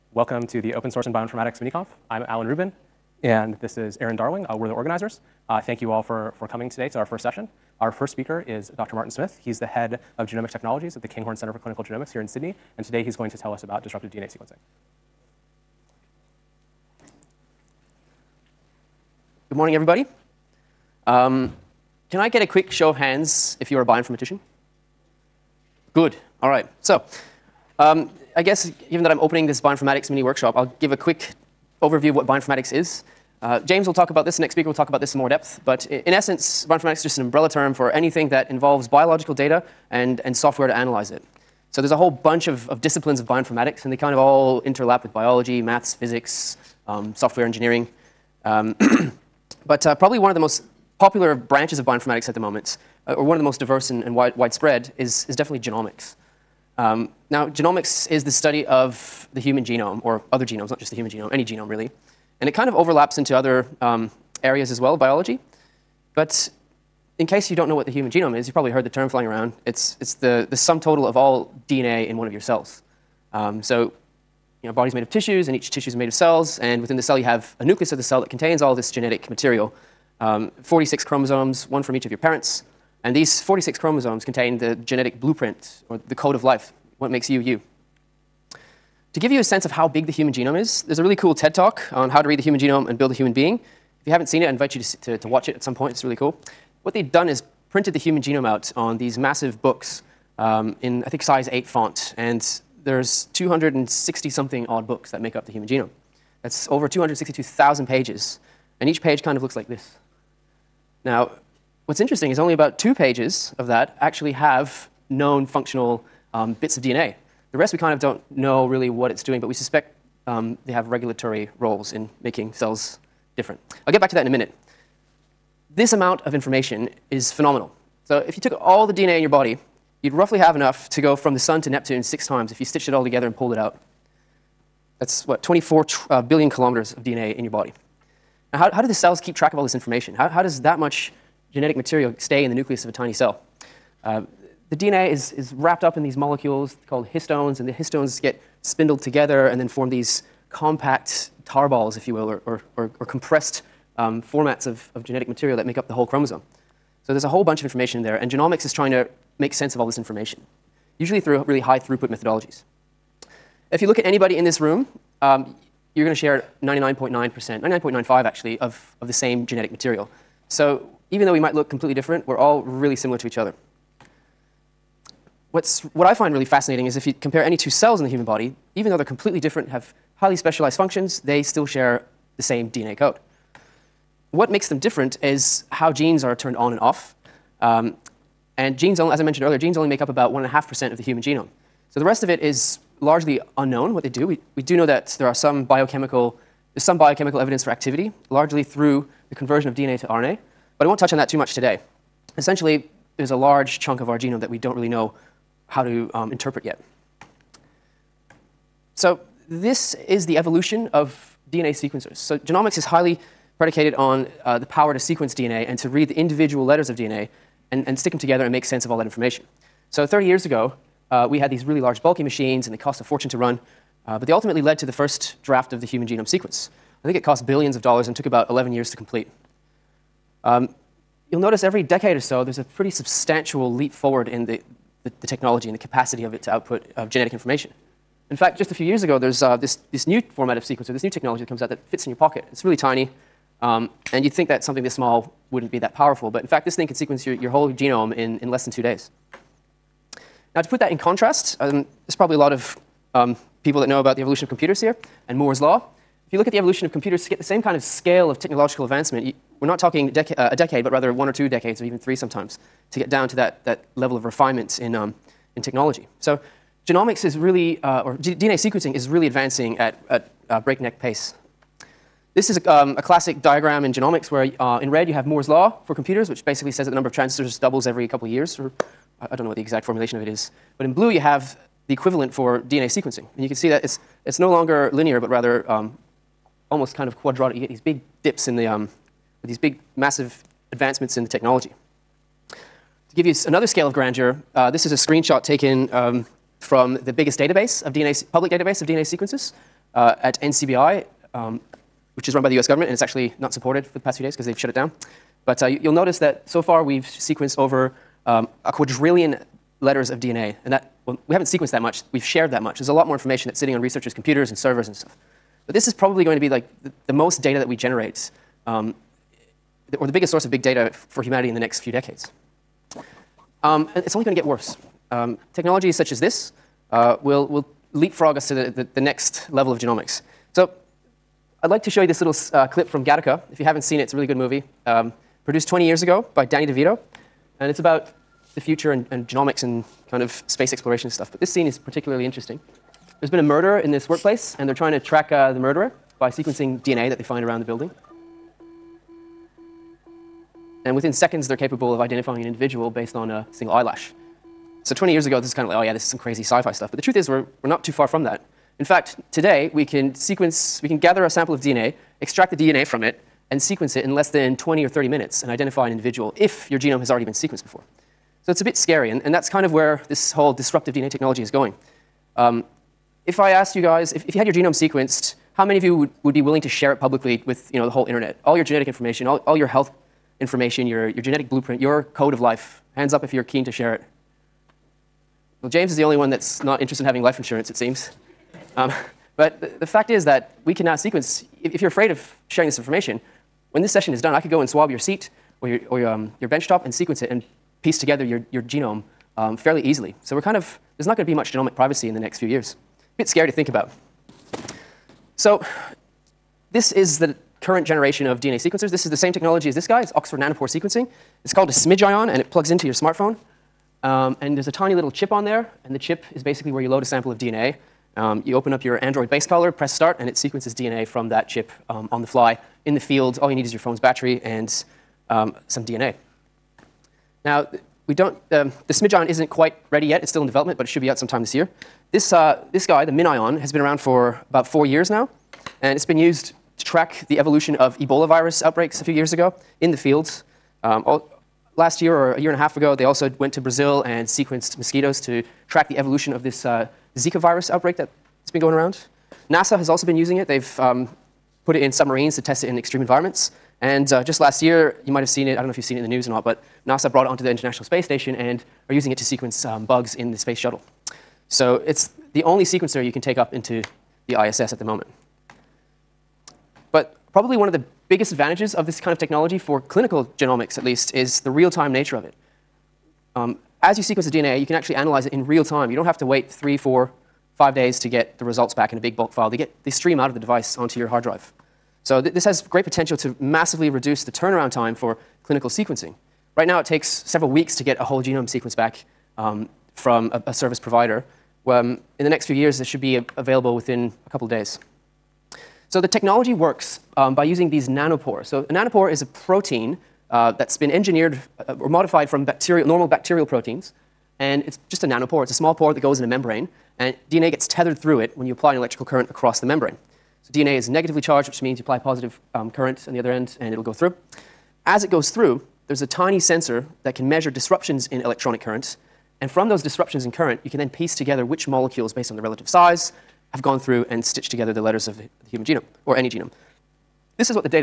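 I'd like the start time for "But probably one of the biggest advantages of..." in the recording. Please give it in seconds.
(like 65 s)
466 s.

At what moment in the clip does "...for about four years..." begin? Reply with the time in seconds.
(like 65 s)
433 s.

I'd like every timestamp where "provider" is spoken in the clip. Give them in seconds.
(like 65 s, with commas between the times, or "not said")
490 s.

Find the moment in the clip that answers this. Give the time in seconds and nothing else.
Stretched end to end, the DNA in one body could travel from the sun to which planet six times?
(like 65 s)
131 s.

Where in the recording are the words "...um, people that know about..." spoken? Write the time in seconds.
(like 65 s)
253 s.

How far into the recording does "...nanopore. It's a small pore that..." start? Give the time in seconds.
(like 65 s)
505 s.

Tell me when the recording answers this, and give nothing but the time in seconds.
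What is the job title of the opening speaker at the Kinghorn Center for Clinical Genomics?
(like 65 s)
9 s.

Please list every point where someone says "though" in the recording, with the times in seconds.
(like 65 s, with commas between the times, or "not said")
171 s, 178 s.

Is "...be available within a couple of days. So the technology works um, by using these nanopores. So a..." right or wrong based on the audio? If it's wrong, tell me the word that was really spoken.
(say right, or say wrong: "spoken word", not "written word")
right.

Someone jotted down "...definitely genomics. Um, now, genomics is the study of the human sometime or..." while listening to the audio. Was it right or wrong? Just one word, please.
wrong.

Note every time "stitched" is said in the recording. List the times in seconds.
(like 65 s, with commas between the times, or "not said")
132 s, 524 s.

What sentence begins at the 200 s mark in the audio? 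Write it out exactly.
But I won't touch on that too much today.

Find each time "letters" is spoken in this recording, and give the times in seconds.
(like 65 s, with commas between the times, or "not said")
216 s, 309 s, 524 s.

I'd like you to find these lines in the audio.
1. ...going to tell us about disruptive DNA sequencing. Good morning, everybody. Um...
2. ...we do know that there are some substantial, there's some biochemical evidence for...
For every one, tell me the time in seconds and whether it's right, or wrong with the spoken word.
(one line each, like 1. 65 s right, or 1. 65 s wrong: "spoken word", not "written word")
1. 13 s right
2. 194 s wrong: "biochemical", not "substantial".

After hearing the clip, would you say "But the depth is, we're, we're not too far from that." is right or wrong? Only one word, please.
wrong.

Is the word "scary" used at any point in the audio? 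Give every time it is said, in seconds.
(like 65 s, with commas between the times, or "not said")
368 s, 403 s.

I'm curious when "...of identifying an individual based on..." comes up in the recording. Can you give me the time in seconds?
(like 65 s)
351 s.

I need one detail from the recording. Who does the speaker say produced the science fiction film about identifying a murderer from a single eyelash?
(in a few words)
Danny DeVito.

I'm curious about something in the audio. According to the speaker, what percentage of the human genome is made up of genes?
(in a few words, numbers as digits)
1.5%.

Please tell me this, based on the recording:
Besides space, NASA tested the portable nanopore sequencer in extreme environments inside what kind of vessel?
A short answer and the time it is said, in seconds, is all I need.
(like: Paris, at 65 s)
Submarines, at 451 s.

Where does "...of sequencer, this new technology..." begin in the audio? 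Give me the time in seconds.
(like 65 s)
240 s.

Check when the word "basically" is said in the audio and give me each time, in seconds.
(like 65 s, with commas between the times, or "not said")
276 s, 416 s.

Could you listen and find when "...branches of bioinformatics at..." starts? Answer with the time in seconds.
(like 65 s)
51 s.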